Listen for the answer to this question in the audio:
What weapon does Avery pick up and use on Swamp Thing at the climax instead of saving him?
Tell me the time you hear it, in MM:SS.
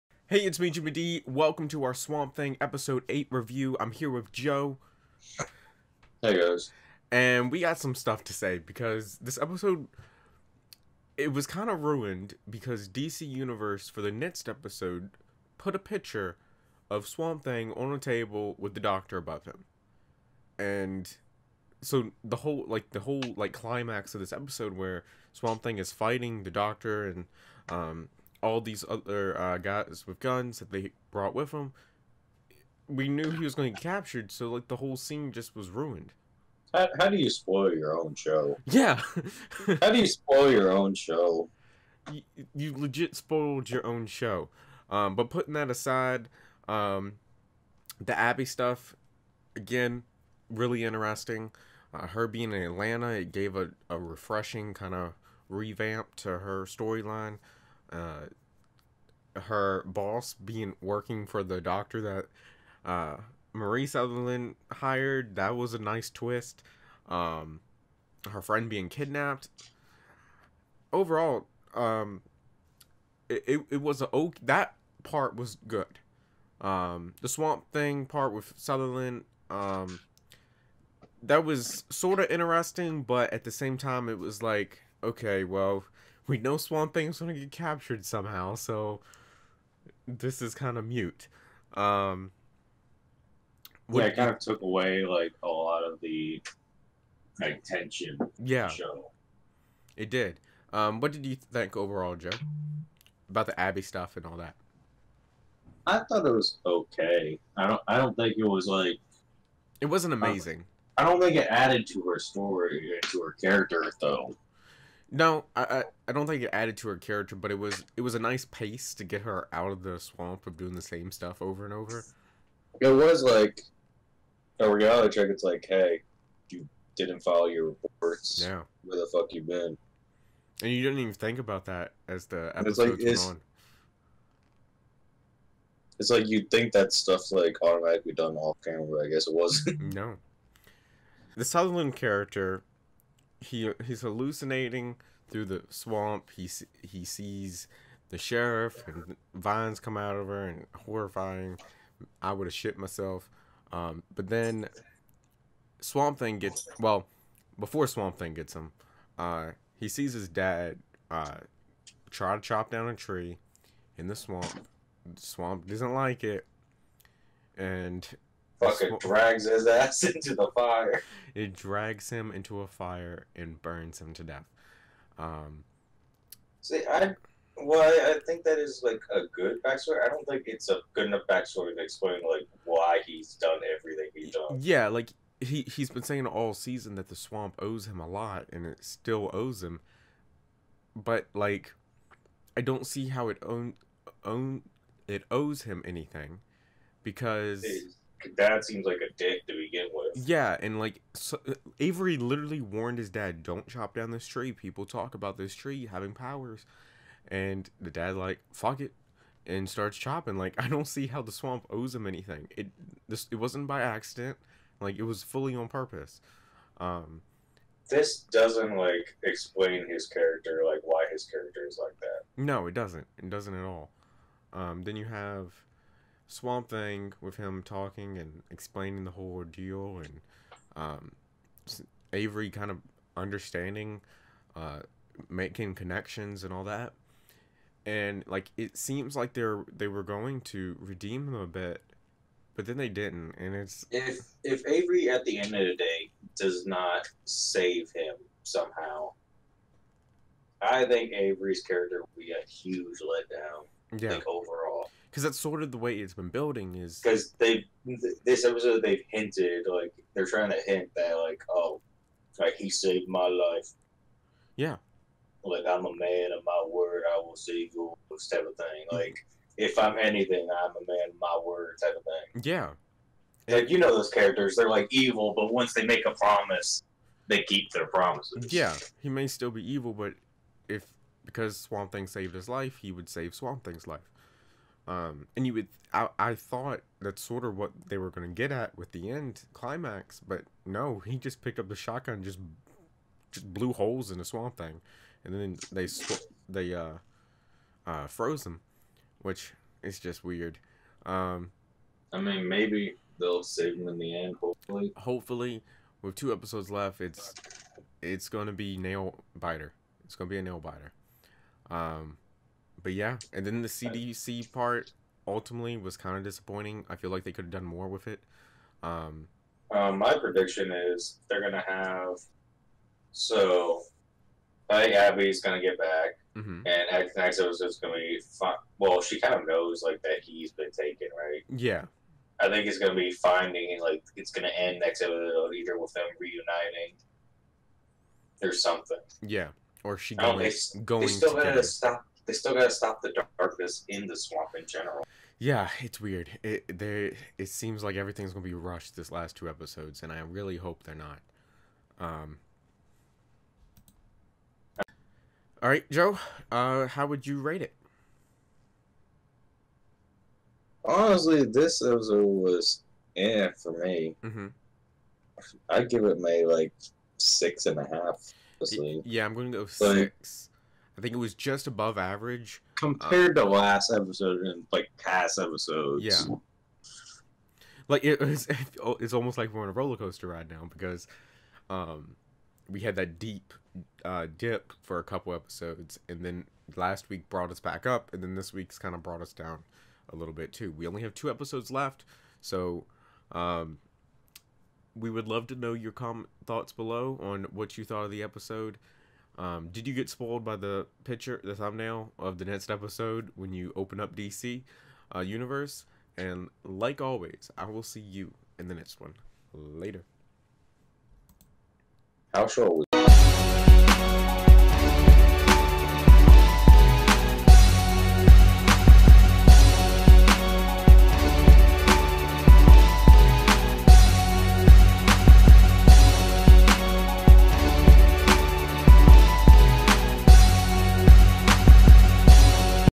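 04:51.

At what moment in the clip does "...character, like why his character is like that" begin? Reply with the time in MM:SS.
03:40.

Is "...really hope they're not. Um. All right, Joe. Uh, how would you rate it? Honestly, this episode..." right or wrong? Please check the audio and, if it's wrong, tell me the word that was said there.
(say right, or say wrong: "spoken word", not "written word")
right.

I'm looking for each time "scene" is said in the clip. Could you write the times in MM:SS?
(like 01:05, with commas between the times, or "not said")
00:34.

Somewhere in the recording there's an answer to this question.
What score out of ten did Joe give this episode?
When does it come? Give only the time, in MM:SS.
06:07.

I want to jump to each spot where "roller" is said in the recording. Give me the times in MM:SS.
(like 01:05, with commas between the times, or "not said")
06:19.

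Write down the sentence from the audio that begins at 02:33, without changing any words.
Um, but then Swamp Thing gets well before Swamp Thing gets him.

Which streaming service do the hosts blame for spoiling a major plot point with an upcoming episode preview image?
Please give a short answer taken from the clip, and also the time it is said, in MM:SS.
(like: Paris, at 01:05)
DC Universe, at 00:12.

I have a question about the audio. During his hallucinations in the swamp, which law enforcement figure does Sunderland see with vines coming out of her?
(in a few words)
the sheriff.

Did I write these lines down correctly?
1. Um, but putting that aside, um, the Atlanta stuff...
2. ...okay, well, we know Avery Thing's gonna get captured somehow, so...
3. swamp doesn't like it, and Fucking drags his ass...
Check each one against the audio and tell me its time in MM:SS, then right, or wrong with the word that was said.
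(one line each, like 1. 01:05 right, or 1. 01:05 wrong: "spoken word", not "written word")
1. 00:44 wrong: "Abby", not "Atlanta"
2. 01:25 wrong: "Swamp", not "Avery"
3. 02:45 right.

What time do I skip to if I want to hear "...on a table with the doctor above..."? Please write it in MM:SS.
00:17.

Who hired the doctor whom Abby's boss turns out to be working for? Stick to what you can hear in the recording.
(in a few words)
Marie Sunderland.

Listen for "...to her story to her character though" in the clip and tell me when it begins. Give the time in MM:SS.
01:51.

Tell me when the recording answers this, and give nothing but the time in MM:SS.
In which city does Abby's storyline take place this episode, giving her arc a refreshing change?
00:52.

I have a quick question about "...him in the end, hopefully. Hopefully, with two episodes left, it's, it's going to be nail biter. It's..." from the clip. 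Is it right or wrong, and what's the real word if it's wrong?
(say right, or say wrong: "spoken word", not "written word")
right.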